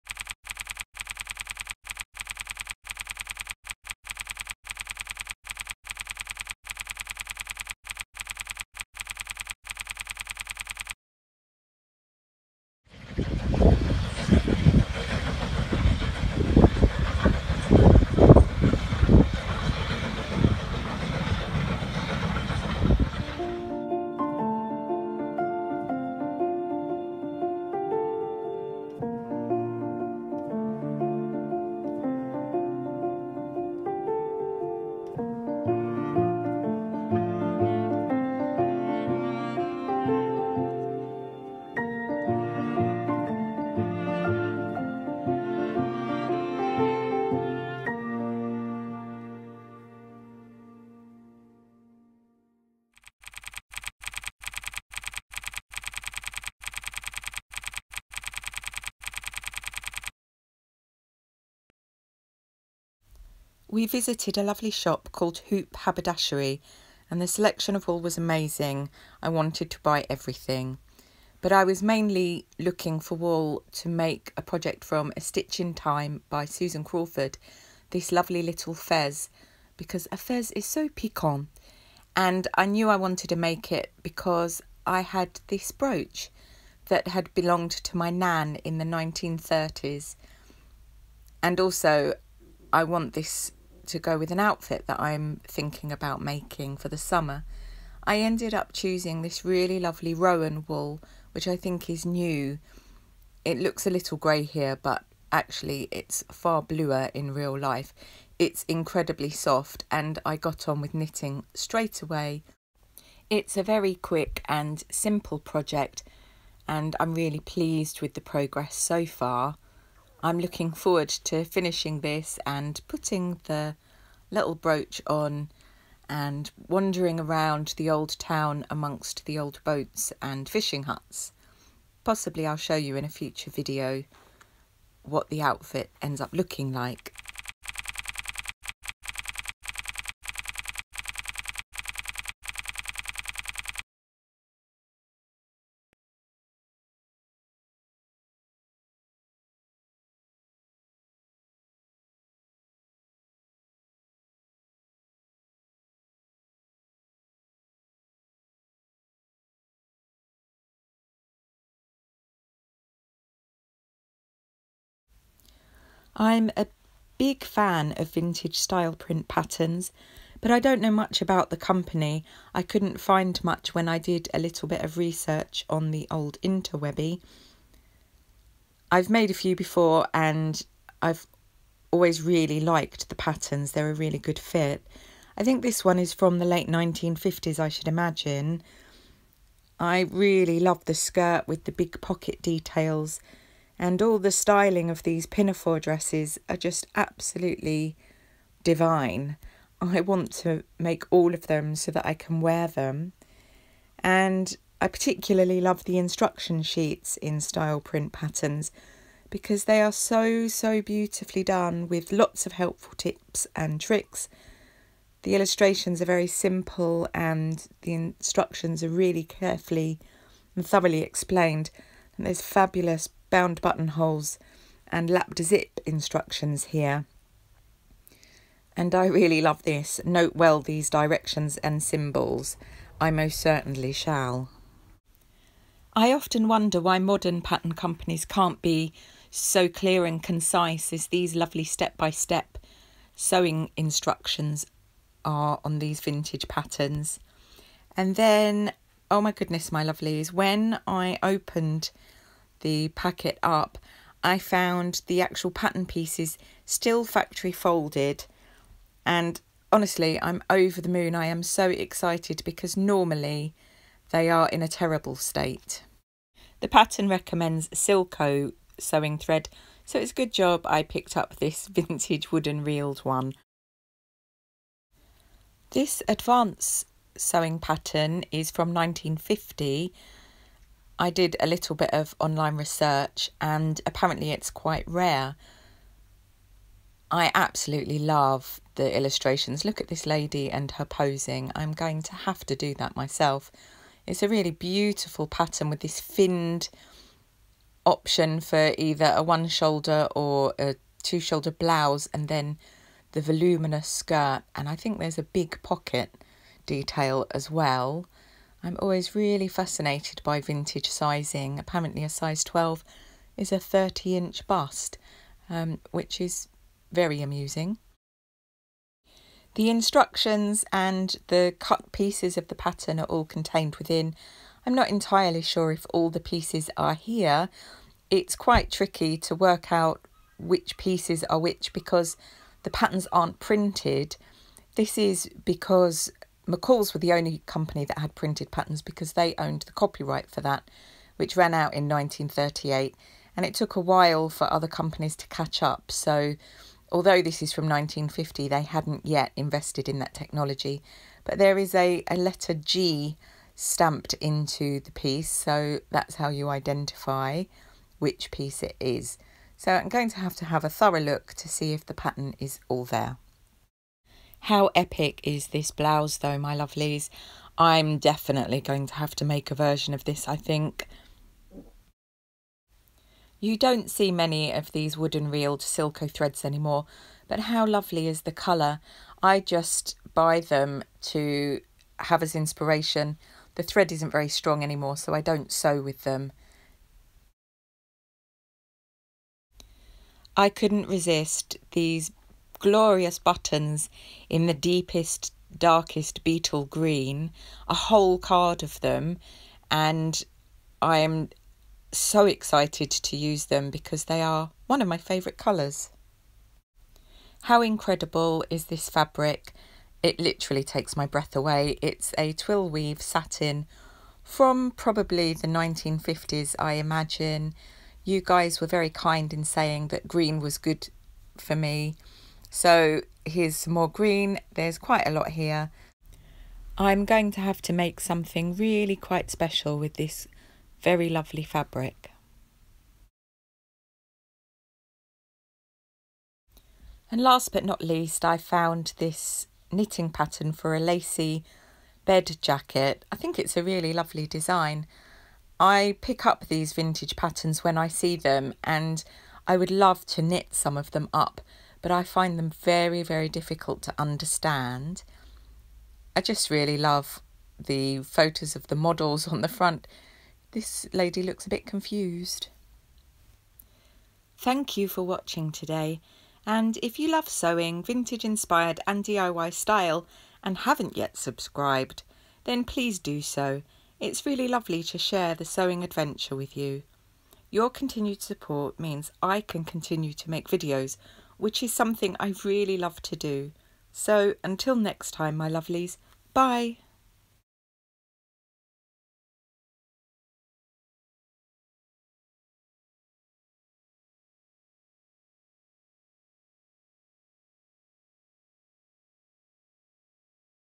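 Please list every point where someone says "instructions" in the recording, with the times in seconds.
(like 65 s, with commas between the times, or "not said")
205 s, 217 s, 225 s, 243 s, 319 s.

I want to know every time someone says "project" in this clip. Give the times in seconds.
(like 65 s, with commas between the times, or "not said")
74 s, 115 s.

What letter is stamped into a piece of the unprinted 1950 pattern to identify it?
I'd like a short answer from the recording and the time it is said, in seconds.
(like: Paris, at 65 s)
G, at 352 s.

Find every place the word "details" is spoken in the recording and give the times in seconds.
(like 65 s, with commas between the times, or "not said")
192 s, 306 s.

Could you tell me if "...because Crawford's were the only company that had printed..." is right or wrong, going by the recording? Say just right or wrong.
wrong.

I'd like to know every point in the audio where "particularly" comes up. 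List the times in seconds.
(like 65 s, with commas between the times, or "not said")
204 s.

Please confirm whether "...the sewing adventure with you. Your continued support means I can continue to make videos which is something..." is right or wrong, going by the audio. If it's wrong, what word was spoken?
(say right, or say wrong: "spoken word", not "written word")
right.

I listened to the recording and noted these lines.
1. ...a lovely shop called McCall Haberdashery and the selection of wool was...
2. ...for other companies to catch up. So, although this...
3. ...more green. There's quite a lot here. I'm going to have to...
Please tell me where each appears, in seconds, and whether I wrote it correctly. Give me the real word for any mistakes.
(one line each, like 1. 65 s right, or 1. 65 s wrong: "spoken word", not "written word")
1. 64 s wrong: "Hoop", not "McCall"
2. 344 s right
3. 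423 s right.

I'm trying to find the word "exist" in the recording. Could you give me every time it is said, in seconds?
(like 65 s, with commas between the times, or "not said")
not said.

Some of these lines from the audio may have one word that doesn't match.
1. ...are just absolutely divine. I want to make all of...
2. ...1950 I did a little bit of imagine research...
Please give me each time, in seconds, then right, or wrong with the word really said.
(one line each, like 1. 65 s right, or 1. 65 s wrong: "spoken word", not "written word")
1. 196 s right
2. 278 s wrong: "online", not "imagine".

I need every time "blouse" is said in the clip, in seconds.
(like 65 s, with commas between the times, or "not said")
301 s, 365 s.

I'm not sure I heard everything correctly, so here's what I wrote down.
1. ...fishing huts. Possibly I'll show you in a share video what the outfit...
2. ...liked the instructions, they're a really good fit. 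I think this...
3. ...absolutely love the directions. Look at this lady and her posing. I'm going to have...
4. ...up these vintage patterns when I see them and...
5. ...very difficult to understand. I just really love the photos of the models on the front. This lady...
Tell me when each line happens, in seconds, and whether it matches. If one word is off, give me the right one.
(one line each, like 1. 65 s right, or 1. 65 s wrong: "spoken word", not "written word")
1. 130 s wrong: "future", not "share"
2. 182 s wrong: "patterns", not "instructions"
3. 287 s wrong: "illustrations", not "directions"
4. 446 s right
5. 453 s right.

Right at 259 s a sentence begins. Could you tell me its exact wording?
And honestly, I'm over the moon.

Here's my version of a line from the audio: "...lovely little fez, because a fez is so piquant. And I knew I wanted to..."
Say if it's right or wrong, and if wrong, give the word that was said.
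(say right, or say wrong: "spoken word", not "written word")
right.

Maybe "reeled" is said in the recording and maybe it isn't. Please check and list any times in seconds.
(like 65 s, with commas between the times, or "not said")
272 s, 375 s.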